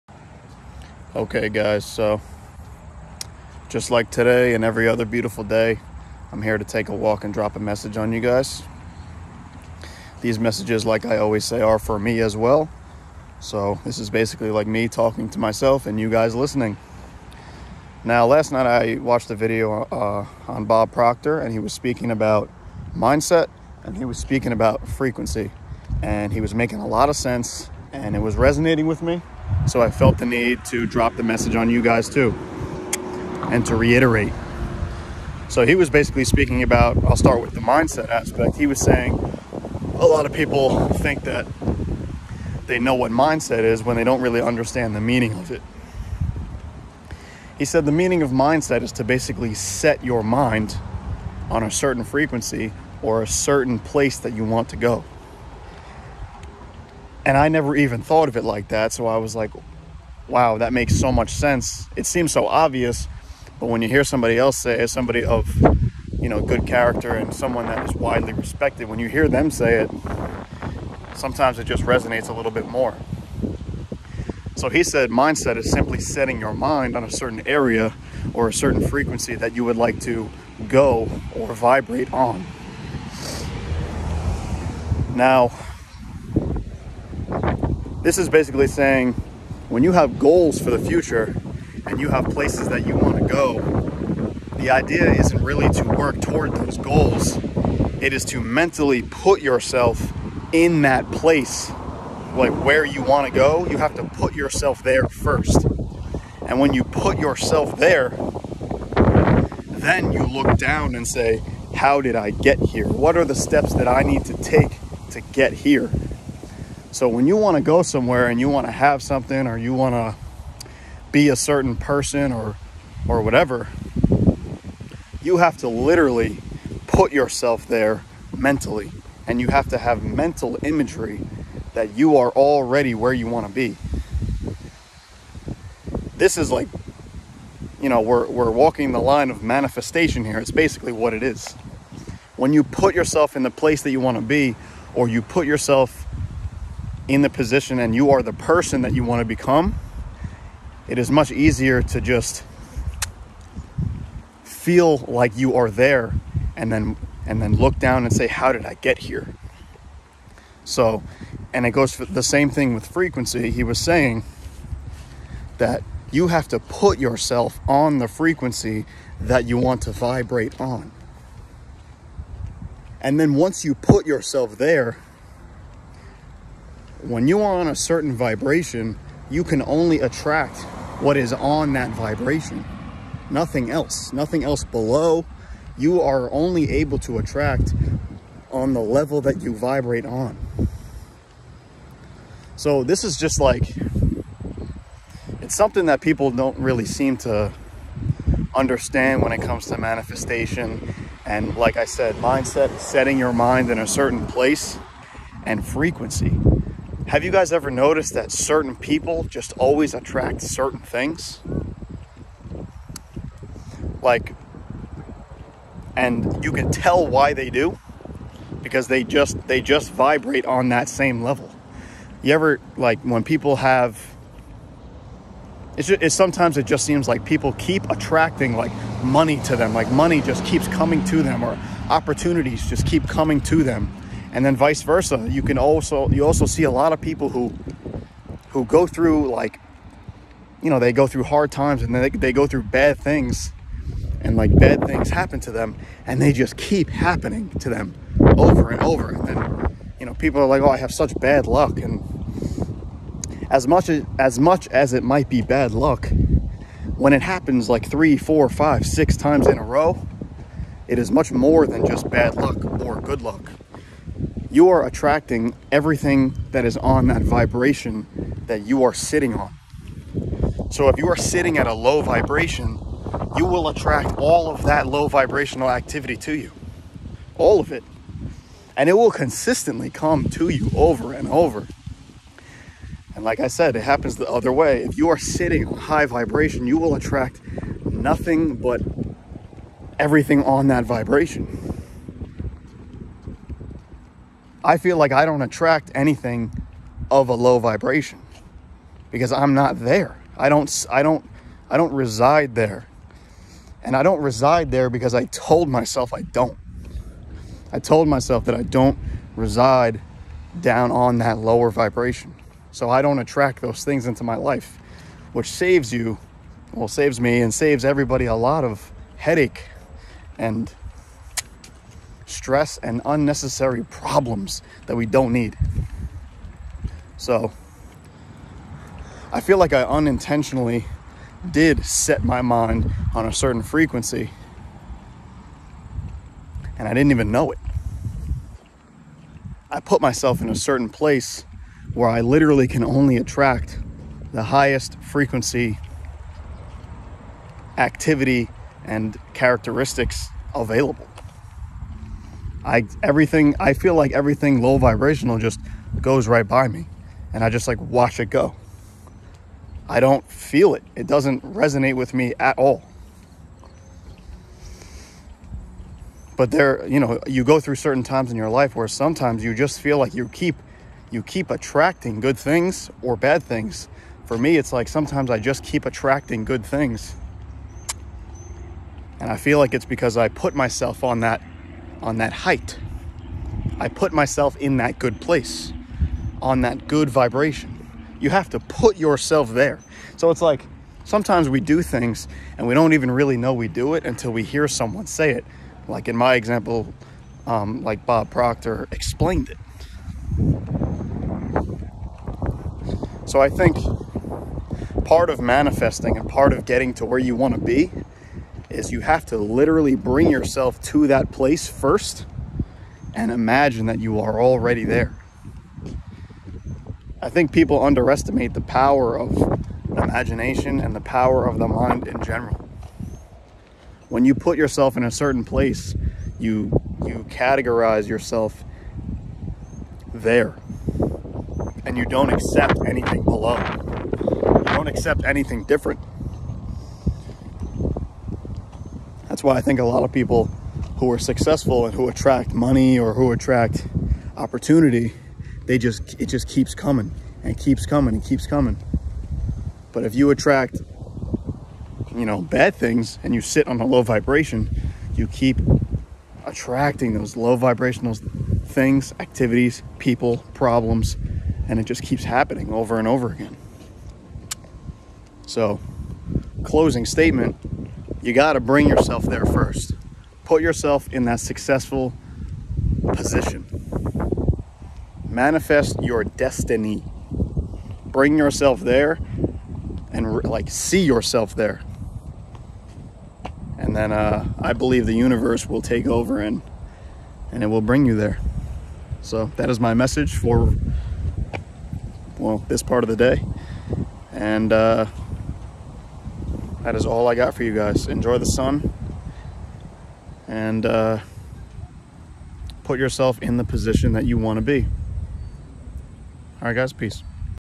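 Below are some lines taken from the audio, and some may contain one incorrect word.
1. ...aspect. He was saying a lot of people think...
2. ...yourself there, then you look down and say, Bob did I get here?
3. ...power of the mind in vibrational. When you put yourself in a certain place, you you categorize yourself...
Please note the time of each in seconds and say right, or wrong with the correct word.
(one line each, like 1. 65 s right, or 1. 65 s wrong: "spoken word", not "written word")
1. 38 s right
2. 107 s wrong: "How", not "Bob"
3. 421 s wrong: "general", not "vibrational".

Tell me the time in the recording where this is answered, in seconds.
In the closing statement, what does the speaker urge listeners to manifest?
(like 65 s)
476 s.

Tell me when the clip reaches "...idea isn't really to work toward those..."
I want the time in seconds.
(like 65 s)
94 s.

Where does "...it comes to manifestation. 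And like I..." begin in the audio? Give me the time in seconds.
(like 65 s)
199 s.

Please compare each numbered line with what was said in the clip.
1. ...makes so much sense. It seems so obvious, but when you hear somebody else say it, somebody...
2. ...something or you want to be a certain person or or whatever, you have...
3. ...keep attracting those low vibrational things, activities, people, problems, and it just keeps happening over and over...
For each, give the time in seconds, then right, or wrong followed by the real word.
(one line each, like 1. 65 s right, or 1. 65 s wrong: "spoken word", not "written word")
1. 60 s right
2. 119 s right
3. 455 s right.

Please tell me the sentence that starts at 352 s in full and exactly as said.
I everything I feel like everything low vibrational just goes right by me and I just like watch it go.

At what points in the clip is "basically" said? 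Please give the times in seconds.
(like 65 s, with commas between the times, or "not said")
14 s, 35 s, 49 s, 88 s, 140 s.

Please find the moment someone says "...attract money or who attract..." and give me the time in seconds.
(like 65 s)
442 s.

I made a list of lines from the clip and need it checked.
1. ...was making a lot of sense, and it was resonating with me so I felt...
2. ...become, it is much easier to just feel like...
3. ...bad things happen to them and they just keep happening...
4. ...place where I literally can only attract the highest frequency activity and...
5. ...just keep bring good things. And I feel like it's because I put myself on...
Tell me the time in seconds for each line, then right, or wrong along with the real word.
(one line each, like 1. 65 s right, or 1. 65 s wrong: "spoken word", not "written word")
1. 26 s right
2. 149 s right
3. 244 s right
4. 340 s right
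5. 375 s wrong: "attracting", not "bring".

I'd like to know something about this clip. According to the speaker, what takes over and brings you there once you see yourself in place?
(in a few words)
the universe.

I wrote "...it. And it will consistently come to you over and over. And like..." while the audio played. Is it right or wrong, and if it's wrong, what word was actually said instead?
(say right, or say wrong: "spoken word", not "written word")
right.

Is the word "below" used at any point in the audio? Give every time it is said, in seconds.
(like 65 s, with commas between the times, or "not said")
184 s, 433 s.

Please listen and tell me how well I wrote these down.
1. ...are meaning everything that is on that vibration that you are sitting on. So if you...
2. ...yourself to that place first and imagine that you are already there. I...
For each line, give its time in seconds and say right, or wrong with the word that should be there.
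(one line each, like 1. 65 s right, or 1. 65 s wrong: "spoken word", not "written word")
1. 264 s wrong: "attracting", not "meaning"
2. 410 s right.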